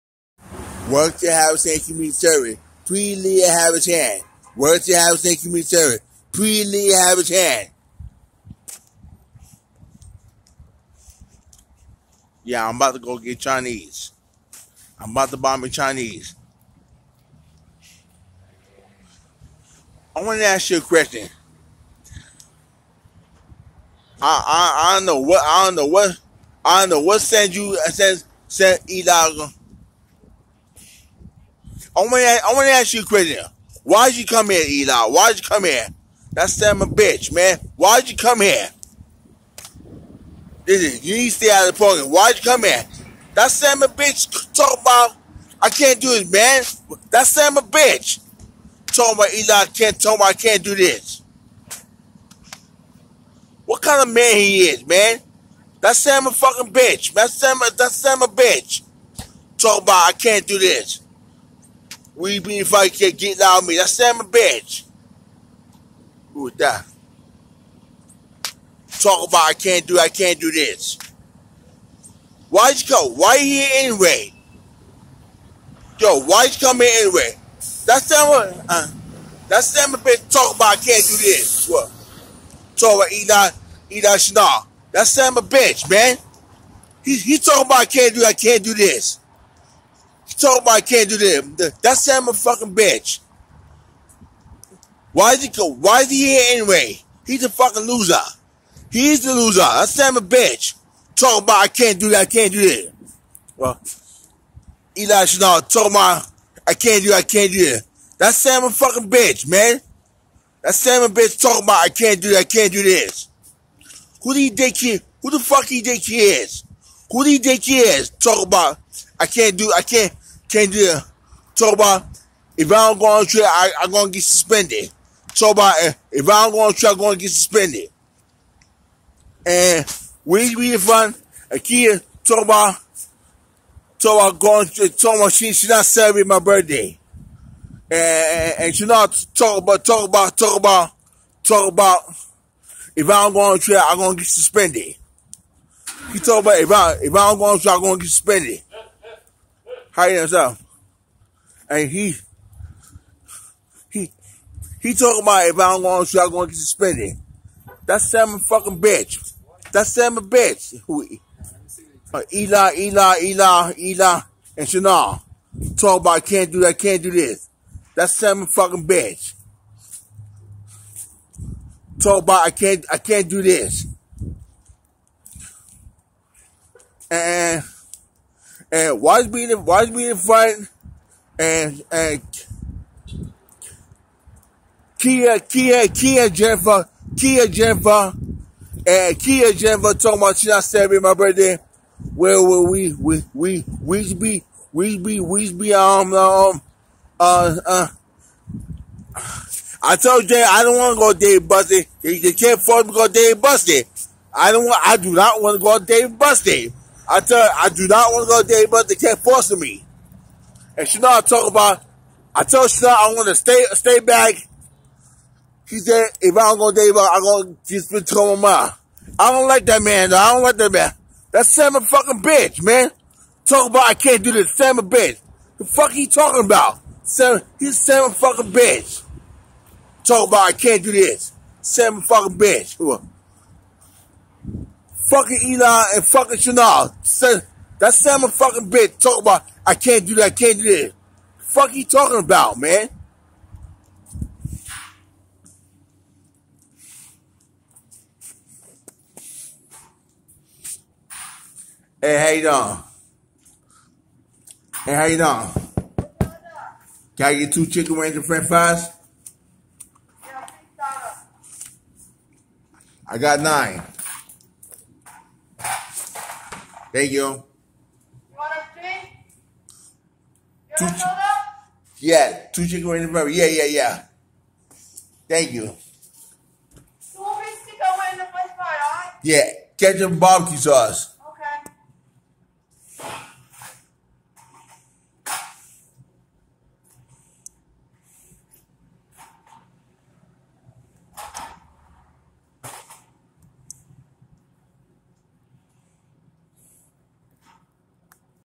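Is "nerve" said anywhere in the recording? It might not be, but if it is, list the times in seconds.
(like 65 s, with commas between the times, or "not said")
not said.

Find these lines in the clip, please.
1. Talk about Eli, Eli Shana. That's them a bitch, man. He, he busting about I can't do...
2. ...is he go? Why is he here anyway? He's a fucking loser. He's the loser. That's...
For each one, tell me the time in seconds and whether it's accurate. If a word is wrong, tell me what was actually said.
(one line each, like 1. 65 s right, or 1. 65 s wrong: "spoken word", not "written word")
1. 82 s wrong: "talking", not "busting"
2. 95 s right.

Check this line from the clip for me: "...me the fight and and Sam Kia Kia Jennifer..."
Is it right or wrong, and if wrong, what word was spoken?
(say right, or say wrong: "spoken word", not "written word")
wrong: "Kia", not "Sam".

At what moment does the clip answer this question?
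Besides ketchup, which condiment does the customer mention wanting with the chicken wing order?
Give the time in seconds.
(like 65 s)
280 s.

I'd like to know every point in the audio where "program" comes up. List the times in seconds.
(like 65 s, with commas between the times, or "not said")
41 s.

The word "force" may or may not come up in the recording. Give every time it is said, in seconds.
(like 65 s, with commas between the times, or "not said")
202 s, 209 s.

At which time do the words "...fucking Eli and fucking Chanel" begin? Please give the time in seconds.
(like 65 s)
235 s.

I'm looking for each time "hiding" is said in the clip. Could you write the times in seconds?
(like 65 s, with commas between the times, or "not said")
150 s.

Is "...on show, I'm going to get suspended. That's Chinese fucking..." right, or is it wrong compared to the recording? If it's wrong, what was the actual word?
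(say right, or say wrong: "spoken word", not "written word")
wrong: "Sam", not "Chinese".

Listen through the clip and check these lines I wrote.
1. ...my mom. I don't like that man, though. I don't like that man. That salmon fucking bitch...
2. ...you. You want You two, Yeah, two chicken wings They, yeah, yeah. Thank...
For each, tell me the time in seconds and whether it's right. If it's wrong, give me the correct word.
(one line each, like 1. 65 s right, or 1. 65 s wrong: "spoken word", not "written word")
1. 218 s right
2. 267 s wrong: "Yeah", not "They".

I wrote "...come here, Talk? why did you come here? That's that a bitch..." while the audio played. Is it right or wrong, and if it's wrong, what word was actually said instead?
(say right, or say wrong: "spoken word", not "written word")
wrong: "Eli", not "Talk".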